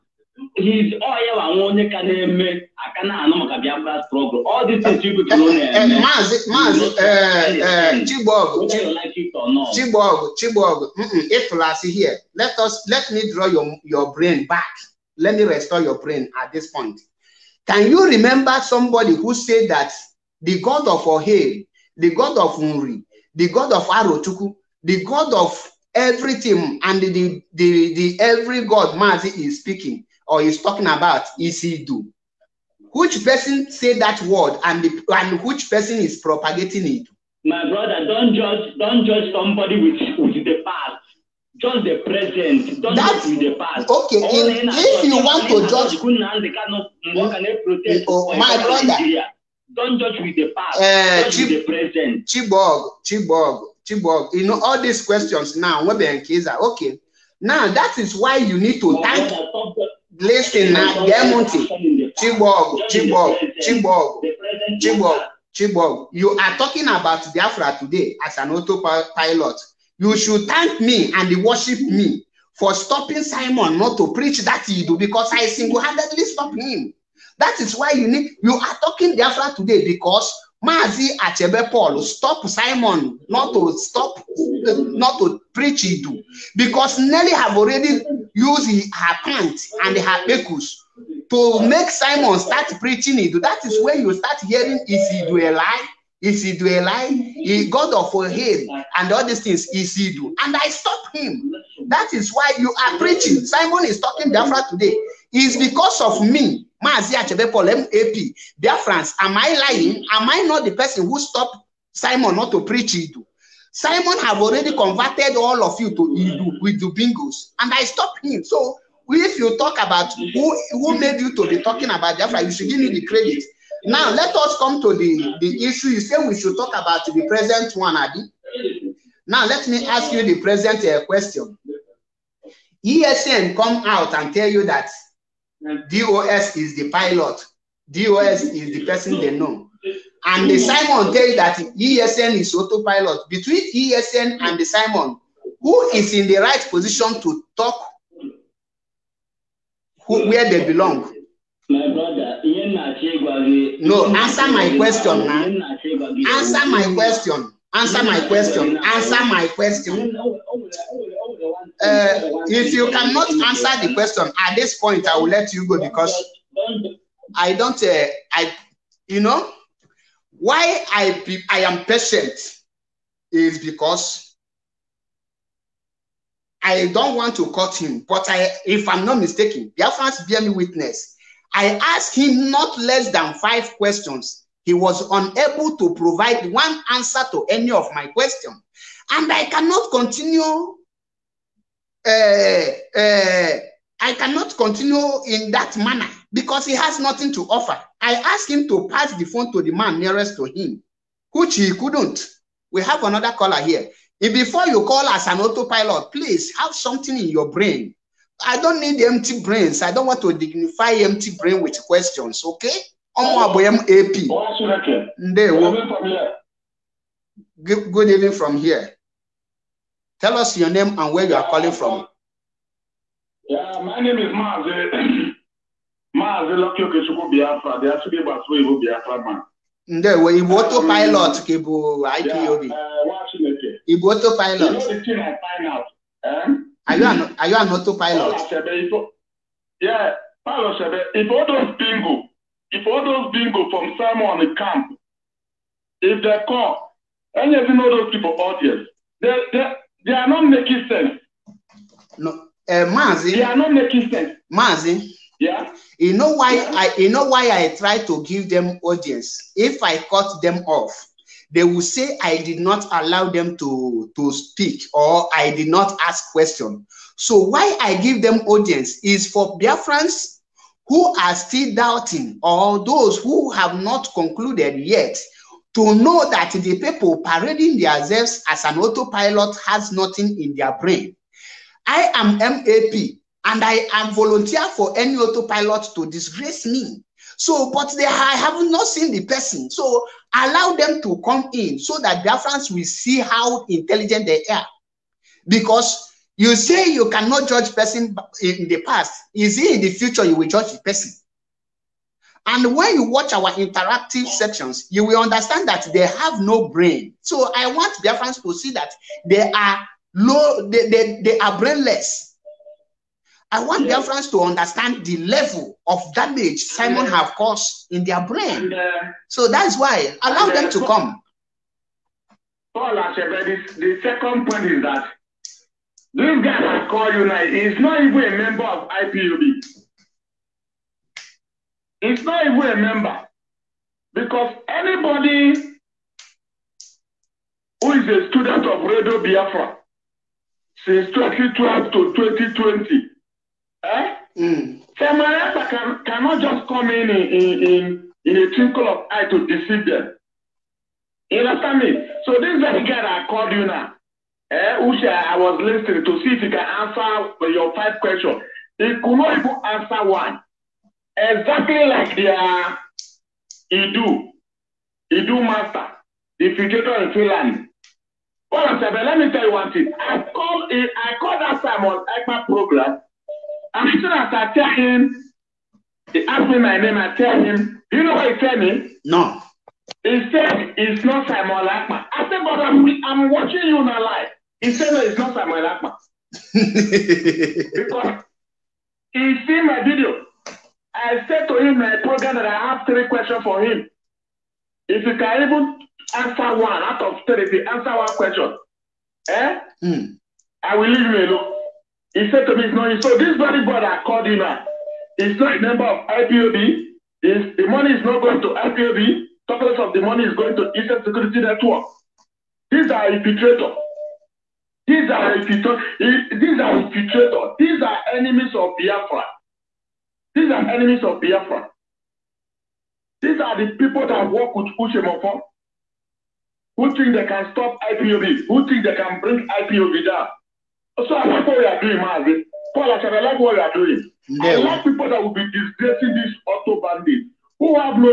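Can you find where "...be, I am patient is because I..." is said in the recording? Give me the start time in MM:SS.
02:51.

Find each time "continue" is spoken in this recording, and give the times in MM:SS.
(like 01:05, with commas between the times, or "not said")
03:09, 03:14.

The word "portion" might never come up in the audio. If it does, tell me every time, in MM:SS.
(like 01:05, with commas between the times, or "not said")
not said.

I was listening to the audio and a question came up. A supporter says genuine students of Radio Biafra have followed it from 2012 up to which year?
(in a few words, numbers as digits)
2020.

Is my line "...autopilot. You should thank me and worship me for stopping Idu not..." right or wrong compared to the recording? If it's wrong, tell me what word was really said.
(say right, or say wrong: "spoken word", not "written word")
wrong: "Simon", not "Idu".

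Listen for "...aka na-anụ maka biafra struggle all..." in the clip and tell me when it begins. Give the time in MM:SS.
00:02.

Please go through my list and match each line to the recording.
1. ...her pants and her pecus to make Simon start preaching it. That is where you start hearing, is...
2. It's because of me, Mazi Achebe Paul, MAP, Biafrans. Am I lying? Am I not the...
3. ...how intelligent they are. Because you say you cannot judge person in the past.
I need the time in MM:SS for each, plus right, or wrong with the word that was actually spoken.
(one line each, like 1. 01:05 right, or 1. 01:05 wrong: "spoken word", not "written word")
1. 01:28 right
2. 01:45 right
3. 04:53 right.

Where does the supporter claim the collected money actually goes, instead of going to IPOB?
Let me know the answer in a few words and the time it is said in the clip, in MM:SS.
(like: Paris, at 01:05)
Eastern Security Network, at 06:50.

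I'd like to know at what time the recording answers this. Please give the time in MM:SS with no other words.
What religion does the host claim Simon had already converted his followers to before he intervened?
01:56.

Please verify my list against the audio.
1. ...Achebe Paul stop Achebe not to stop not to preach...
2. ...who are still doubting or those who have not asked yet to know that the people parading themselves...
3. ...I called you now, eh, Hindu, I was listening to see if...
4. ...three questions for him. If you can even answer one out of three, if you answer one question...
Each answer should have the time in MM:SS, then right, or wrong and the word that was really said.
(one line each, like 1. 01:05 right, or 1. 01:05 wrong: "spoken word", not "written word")
1. 01:21 wrong: "Simon", not "Achebe"
2. 04:30 wrong: "concluded", not "asked"
3. 05:53 wrong: "Usha", not "Hindu"
4. 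06:32 right.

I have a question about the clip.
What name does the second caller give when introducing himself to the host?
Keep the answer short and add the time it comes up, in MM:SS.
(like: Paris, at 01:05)
Lucky Okechukwu, at 03:46.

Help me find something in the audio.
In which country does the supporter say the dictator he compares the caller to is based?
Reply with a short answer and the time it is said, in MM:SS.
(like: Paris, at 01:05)
Finland, at 06:07.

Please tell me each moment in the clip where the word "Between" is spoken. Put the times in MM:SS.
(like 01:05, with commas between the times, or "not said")
02:23.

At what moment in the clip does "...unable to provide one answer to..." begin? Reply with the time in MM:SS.
03:05.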